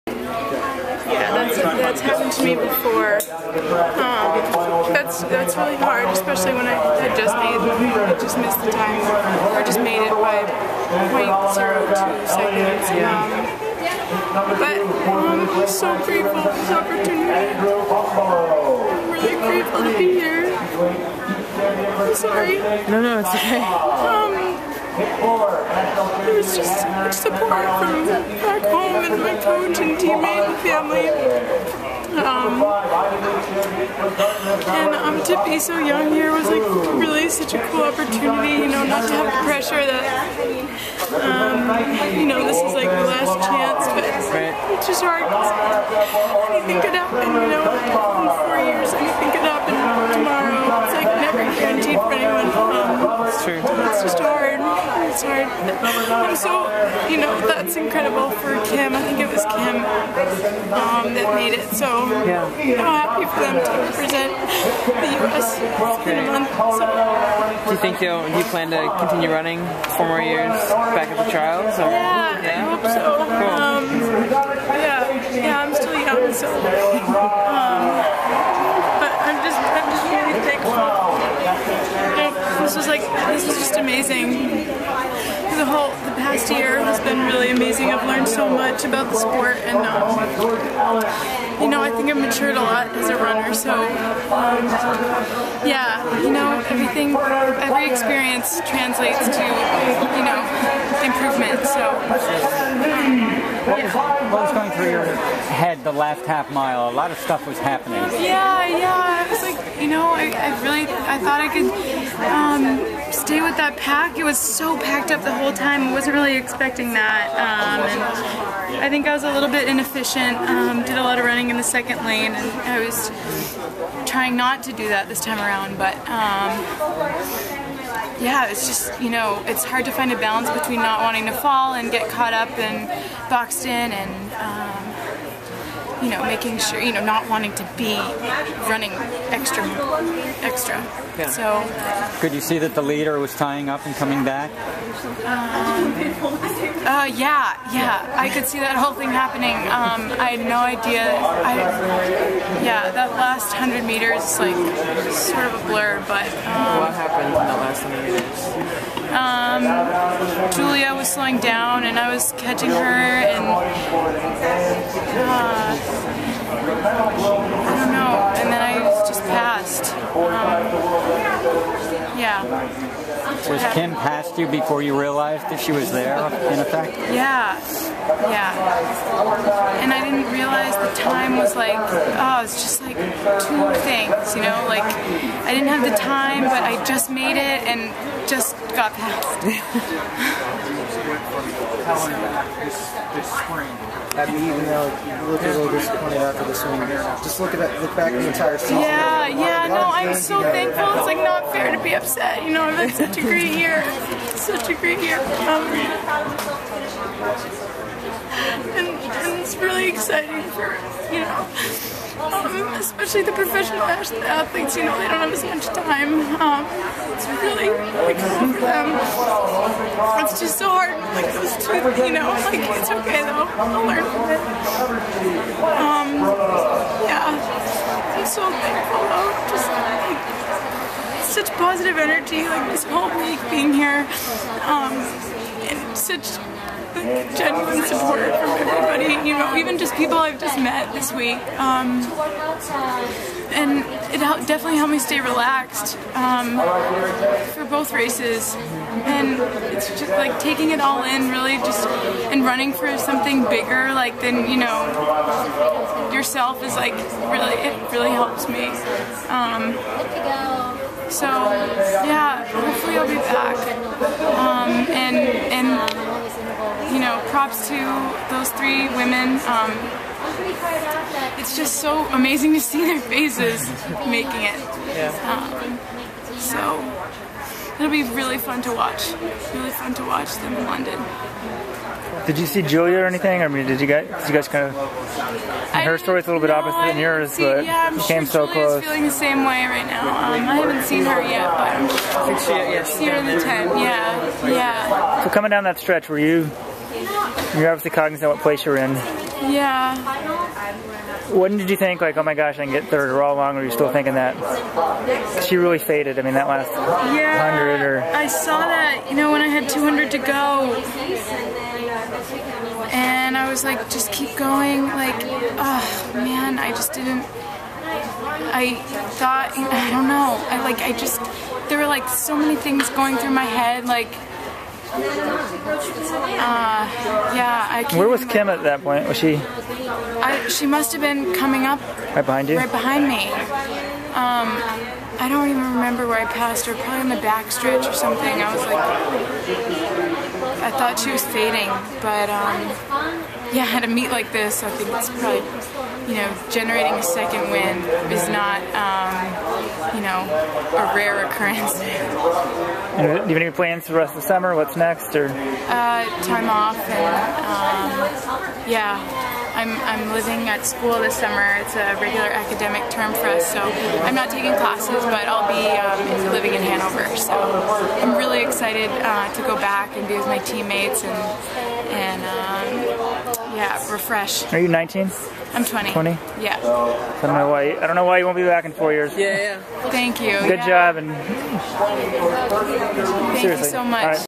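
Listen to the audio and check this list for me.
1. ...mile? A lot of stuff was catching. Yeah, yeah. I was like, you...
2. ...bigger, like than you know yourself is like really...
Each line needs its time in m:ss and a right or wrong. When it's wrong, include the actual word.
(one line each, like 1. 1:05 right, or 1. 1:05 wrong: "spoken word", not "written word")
1. 1:46 wrong: "happening", not "catching"
2. 4:13 right.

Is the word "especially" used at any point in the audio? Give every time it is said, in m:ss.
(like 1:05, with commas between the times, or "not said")
0:06, 3:32.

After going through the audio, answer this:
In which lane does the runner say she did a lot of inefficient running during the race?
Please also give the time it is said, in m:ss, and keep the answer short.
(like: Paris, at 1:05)
second lane, at 2:01.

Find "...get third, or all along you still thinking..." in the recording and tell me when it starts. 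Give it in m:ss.
5:02.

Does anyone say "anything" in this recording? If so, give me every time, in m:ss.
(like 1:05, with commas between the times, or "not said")
0:46, 4:43.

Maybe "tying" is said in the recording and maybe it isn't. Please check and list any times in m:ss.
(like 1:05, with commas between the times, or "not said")
2:23.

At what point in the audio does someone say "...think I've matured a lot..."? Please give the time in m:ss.
1:31.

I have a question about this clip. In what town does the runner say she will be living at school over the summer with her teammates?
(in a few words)
Hanover.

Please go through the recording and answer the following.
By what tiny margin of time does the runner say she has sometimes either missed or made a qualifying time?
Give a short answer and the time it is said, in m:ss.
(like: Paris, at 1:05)
0.02 seconds, at 0:11.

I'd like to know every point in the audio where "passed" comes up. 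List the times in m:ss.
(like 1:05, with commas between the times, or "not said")
2:49, 5:36.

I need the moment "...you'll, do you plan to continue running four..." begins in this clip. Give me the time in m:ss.
1:08.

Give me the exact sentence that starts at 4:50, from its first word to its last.
Um, I haven't seen her yet, but I'm sure.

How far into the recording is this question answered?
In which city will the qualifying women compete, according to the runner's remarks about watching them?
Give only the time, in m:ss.
4:40.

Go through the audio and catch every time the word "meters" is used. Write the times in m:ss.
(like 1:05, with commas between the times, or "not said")
2:33, 2:38.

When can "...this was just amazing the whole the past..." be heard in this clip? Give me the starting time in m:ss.
1:23.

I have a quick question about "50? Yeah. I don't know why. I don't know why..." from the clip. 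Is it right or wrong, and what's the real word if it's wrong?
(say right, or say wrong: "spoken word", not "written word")
wrong: "20", not "50".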